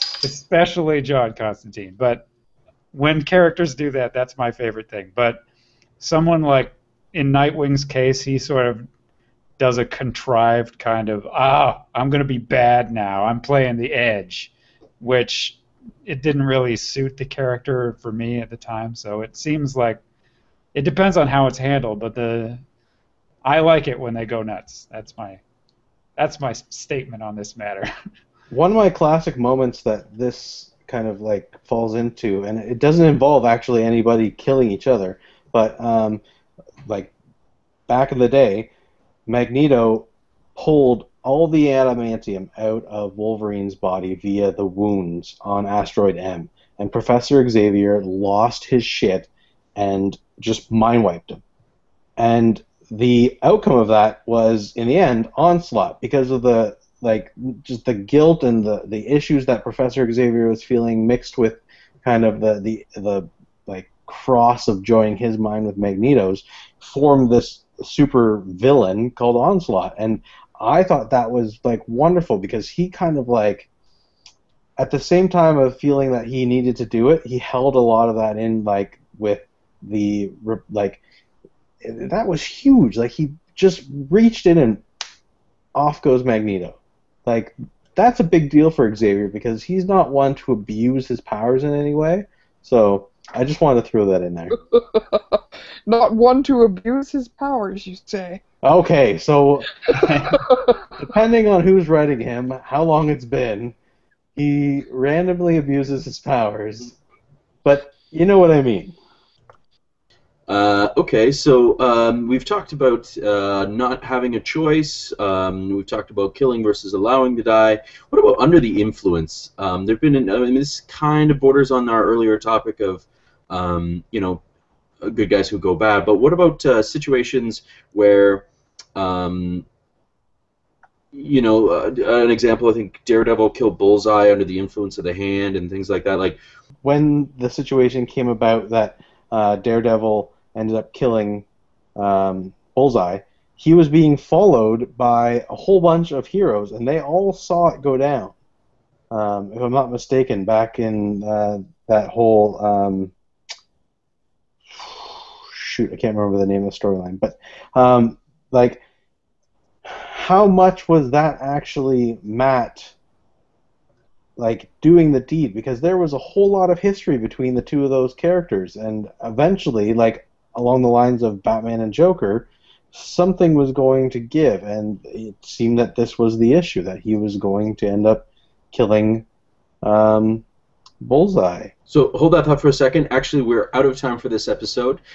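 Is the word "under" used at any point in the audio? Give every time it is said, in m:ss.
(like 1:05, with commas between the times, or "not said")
1:58, 2:14.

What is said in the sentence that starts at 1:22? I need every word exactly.
Like he just reached in and off goes Magneto.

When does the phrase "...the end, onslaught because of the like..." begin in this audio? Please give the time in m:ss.
0:54.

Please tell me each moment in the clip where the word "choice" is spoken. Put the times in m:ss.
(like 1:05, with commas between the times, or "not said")
1:54.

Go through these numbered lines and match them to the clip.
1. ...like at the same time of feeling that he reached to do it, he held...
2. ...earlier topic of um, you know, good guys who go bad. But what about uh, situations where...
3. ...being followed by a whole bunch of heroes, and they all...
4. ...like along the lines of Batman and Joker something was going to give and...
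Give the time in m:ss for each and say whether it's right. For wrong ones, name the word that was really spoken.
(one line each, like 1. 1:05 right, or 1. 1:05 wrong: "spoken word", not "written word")
1. 1:13 wrong: "needed", not "reached"
2. 2:02 right
3. 2:23 right
4. 2:49 right.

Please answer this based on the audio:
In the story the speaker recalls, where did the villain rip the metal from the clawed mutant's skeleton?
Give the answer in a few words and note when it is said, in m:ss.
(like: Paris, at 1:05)
Asteroid M, at 0:45.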